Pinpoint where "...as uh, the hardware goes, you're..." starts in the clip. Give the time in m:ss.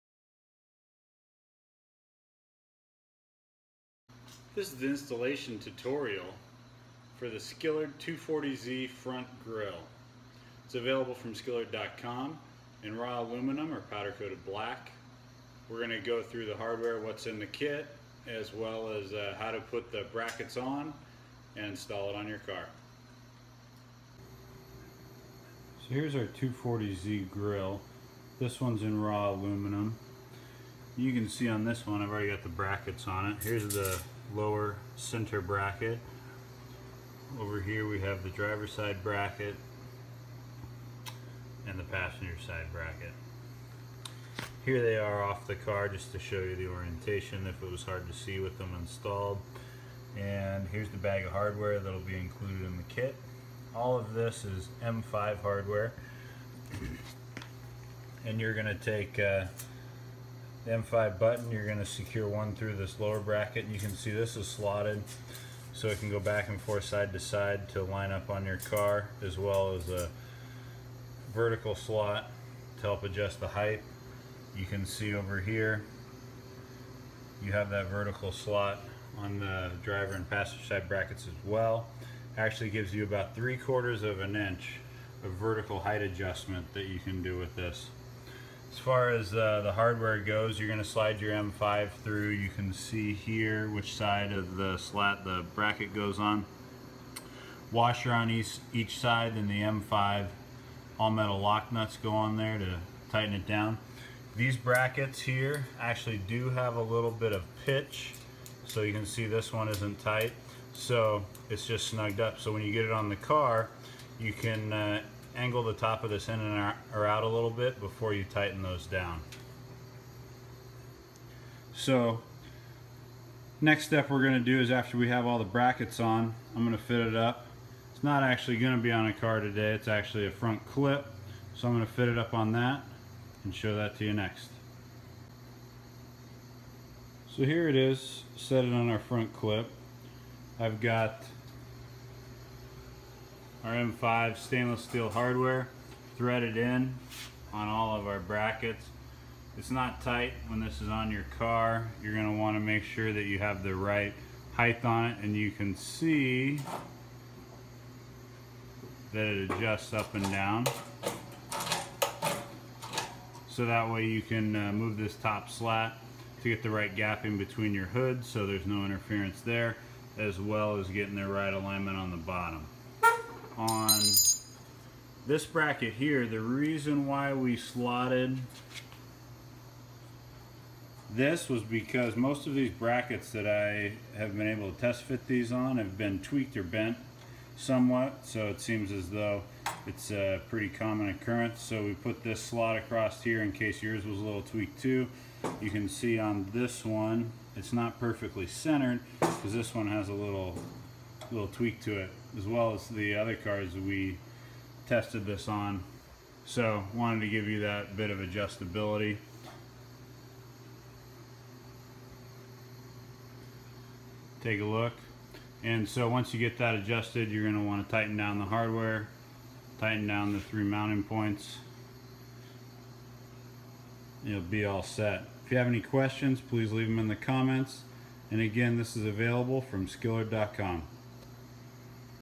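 1:29.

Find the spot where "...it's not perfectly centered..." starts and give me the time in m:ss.
3:17.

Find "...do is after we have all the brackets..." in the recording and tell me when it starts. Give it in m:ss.
2:04.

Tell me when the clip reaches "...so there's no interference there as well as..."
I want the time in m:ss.
2:48.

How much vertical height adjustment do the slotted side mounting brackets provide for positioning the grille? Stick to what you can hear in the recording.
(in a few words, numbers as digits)
3/4 of an inch.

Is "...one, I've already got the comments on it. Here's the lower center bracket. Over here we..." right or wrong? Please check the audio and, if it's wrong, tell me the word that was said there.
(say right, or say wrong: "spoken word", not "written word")
wrong: "brackets", not "comments".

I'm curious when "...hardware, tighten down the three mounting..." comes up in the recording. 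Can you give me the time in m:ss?
3:38.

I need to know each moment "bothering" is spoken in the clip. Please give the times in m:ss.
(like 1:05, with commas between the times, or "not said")
not said.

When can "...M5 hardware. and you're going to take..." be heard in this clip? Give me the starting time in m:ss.
0:54.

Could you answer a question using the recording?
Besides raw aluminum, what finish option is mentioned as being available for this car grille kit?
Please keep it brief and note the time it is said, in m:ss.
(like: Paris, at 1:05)
Powder coated black, at 0:13.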